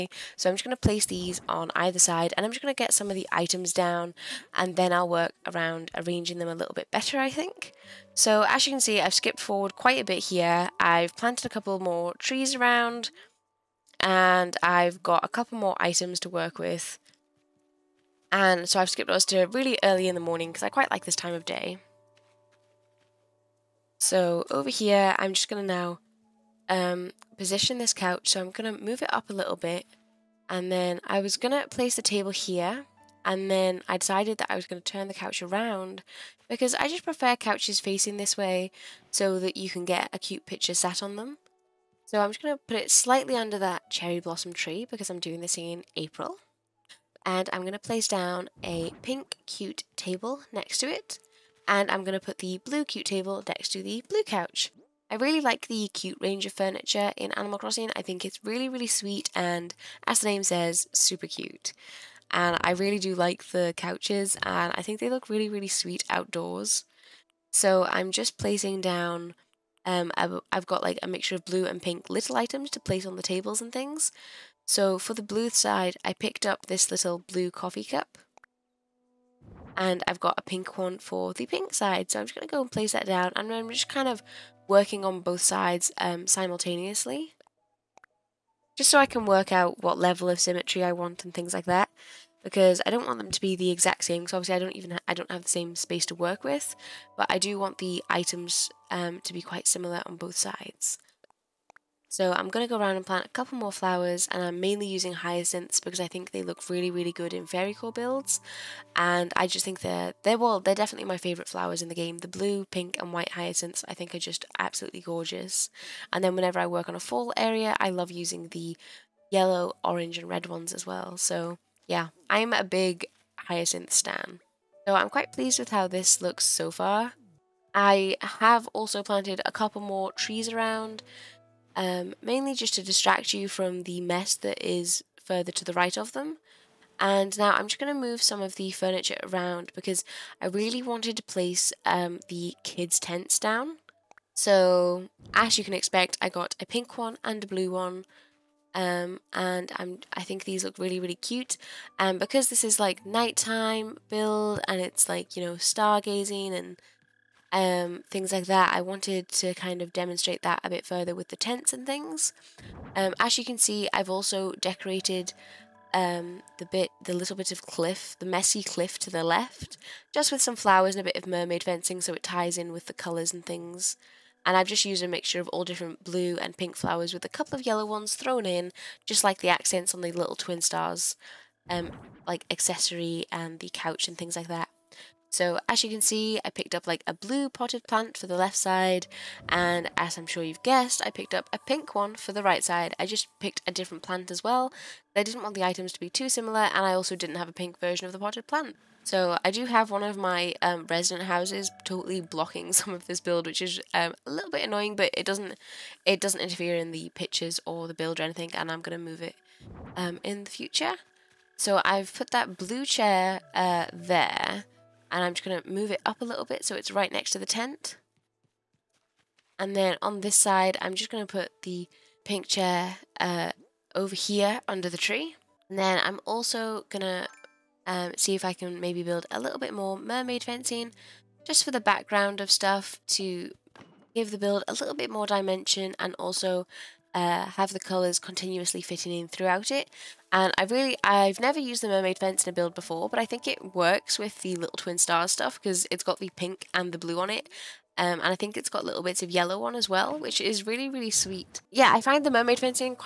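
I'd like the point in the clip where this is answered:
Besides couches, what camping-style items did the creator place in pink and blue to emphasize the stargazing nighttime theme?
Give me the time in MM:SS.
02:22.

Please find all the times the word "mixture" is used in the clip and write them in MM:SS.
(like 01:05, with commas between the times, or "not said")
01:11, 02:55.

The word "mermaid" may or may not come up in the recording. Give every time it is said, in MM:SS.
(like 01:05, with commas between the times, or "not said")
02:51, 03:49, 04:01, 04:12.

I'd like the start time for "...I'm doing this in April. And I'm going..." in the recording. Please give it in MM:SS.
00:45.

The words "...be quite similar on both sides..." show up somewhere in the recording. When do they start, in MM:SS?
01:39.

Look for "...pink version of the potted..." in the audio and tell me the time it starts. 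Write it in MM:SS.
03:17.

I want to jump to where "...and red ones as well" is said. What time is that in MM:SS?
02:00.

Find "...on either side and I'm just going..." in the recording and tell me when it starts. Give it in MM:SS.
00:01.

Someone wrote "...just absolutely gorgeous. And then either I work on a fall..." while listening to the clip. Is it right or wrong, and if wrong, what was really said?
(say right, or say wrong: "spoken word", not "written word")
wrong: "whenever", not "either".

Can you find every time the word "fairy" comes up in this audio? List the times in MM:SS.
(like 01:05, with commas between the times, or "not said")
01:47.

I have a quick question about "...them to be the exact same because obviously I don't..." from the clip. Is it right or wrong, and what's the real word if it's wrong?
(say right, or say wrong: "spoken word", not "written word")
right.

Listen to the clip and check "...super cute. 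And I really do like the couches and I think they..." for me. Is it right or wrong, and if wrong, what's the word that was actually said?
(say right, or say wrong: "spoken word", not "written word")
right.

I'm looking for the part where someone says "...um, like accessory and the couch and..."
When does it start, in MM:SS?
03:01.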